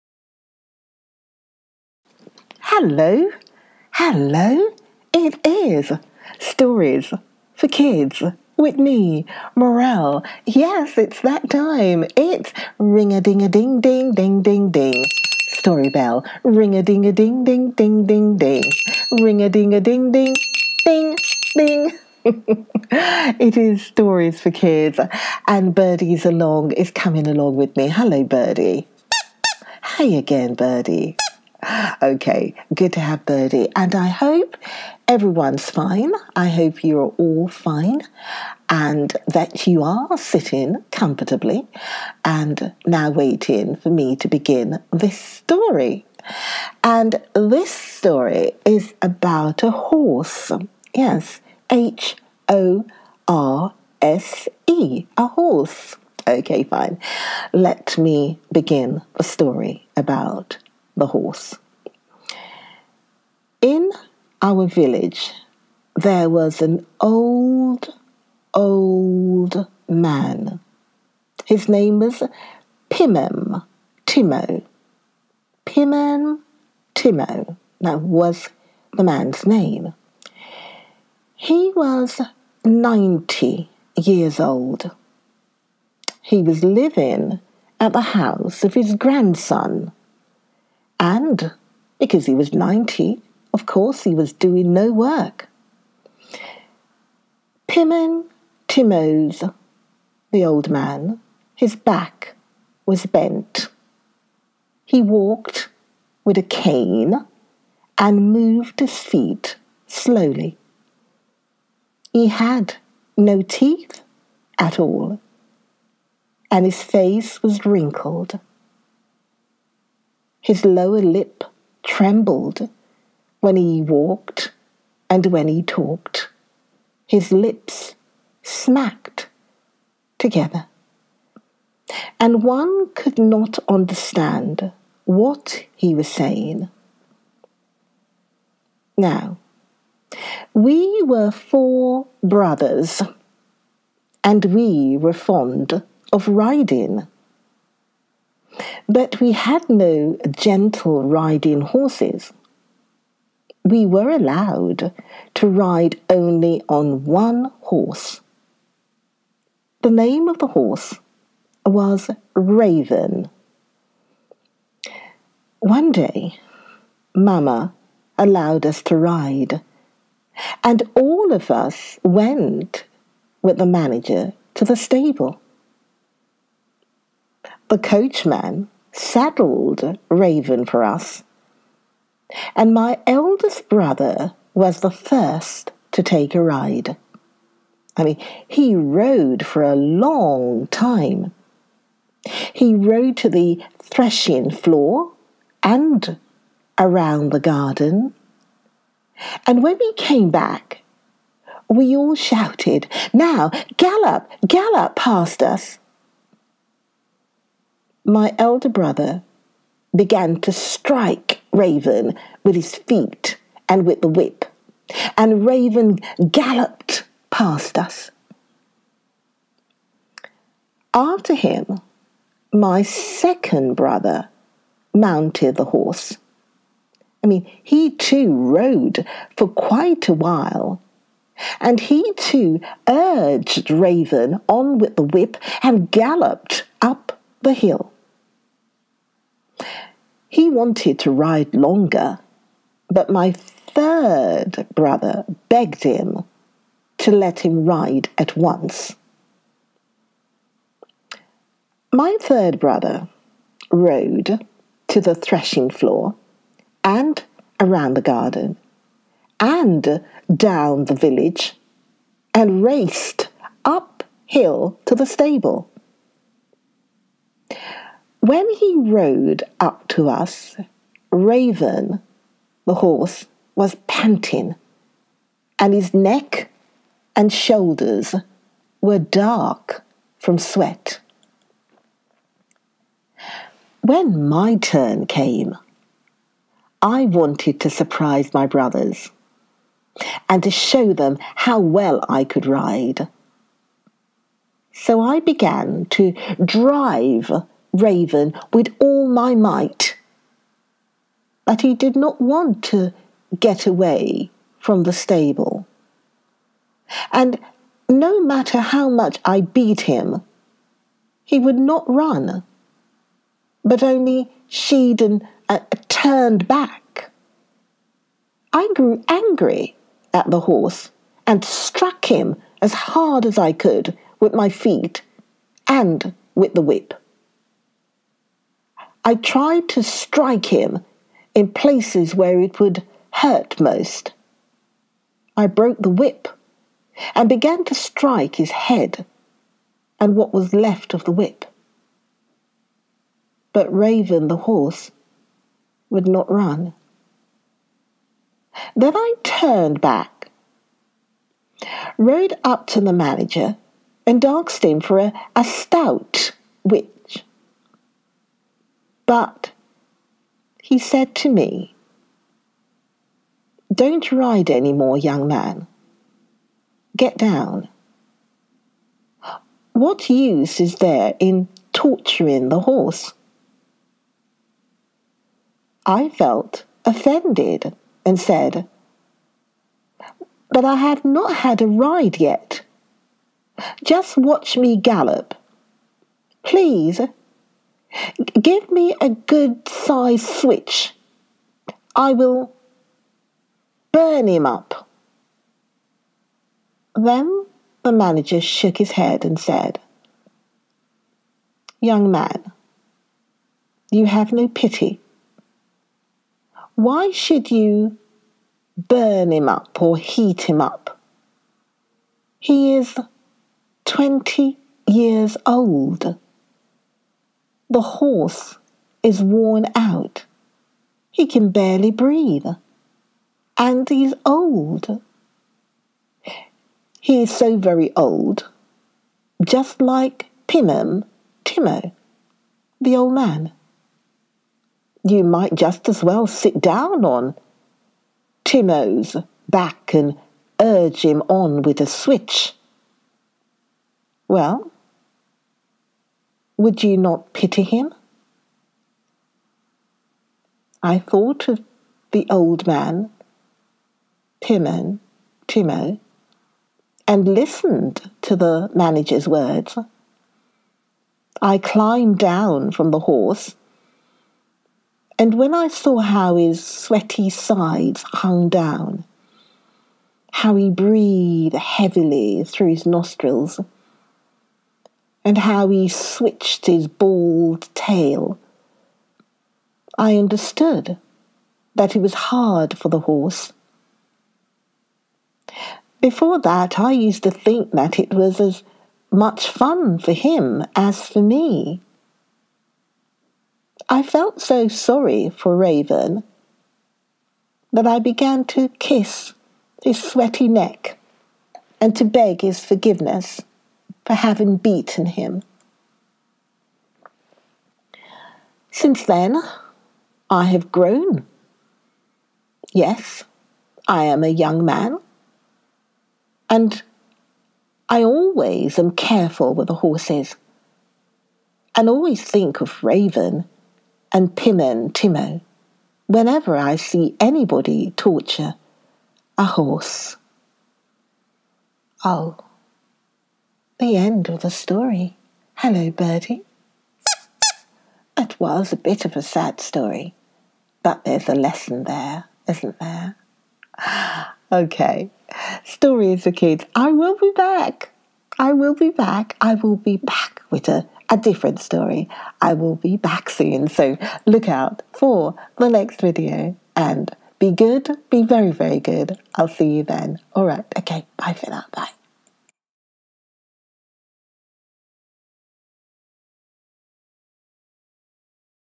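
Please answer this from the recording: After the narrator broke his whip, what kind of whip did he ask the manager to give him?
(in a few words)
a stout whip.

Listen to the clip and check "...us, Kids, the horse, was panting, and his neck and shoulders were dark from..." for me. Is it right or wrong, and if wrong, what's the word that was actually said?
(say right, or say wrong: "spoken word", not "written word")
wrong: "Raven", not "Kids".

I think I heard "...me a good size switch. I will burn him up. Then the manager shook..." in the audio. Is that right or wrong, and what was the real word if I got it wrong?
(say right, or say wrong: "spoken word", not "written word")
right.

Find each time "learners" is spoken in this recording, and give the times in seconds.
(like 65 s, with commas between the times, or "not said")
not said.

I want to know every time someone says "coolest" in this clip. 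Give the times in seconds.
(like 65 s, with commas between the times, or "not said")
not said.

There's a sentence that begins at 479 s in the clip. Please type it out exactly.
I understood that it was hard for the horse.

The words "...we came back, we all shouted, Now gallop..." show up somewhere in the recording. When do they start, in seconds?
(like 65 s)
199 s.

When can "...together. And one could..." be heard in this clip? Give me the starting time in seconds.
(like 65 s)
130 s.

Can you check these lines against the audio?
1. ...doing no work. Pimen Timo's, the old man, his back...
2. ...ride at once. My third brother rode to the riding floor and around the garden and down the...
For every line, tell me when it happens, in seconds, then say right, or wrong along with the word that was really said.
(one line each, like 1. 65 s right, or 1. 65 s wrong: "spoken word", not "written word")
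1. 94 s right
2. 247 s wrong: "threshing", not "riding".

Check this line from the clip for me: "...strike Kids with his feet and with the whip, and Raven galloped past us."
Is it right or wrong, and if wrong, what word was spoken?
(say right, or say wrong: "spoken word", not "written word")
wrong: "Raven", not "Kids".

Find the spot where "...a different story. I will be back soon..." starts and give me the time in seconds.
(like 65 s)
551 s.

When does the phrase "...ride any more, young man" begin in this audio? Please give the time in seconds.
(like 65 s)
364 s.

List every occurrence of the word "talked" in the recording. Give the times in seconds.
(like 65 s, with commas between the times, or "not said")
125 s.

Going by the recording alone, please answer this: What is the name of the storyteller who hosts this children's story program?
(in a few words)
Morel.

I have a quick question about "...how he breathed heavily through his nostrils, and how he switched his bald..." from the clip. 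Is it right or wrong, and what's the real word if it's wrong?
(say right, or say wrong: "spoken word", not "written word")
right.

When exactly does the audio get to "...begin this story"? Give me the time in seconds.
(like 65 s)
44 s.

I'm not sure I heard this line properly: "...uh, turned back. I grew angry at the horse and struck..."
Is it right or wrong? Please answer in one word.
right.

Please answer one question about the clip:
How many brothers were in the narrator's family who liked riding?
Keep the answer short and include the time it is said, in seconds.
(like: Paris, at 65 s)
4, at 141 s.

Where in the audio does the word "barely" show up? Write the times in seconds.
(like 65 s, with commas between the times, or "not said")
421 s.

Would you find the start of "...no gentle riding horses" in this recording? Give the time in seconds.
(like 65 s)
149 s.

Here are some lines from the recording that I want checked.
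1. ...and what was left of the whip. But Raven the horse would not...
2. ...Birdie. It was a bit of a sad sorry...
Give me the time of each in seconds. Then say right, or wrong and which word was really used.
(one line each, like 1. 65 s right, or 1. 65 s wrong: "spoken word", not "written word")
1. 339 s right
2. 535 s wrong: "story", not "sorry".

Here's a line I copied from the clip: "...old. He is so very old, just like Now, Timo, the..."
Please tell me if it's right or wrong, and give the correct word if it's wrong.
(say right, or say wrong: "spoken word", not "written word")
wrong: "Pimen", not "Now".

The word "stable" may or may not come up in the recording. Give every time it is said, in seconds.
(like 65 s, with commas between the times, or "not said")
174 s, 265 s, 304 s.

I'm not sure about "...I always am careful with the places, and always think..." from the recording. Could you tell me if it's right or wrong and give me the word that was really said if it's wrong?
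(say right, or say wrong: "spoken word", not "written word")
wrong: "horses", not "places".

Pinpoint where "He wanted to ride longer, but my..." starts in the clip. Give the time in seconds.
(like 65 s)
240 s.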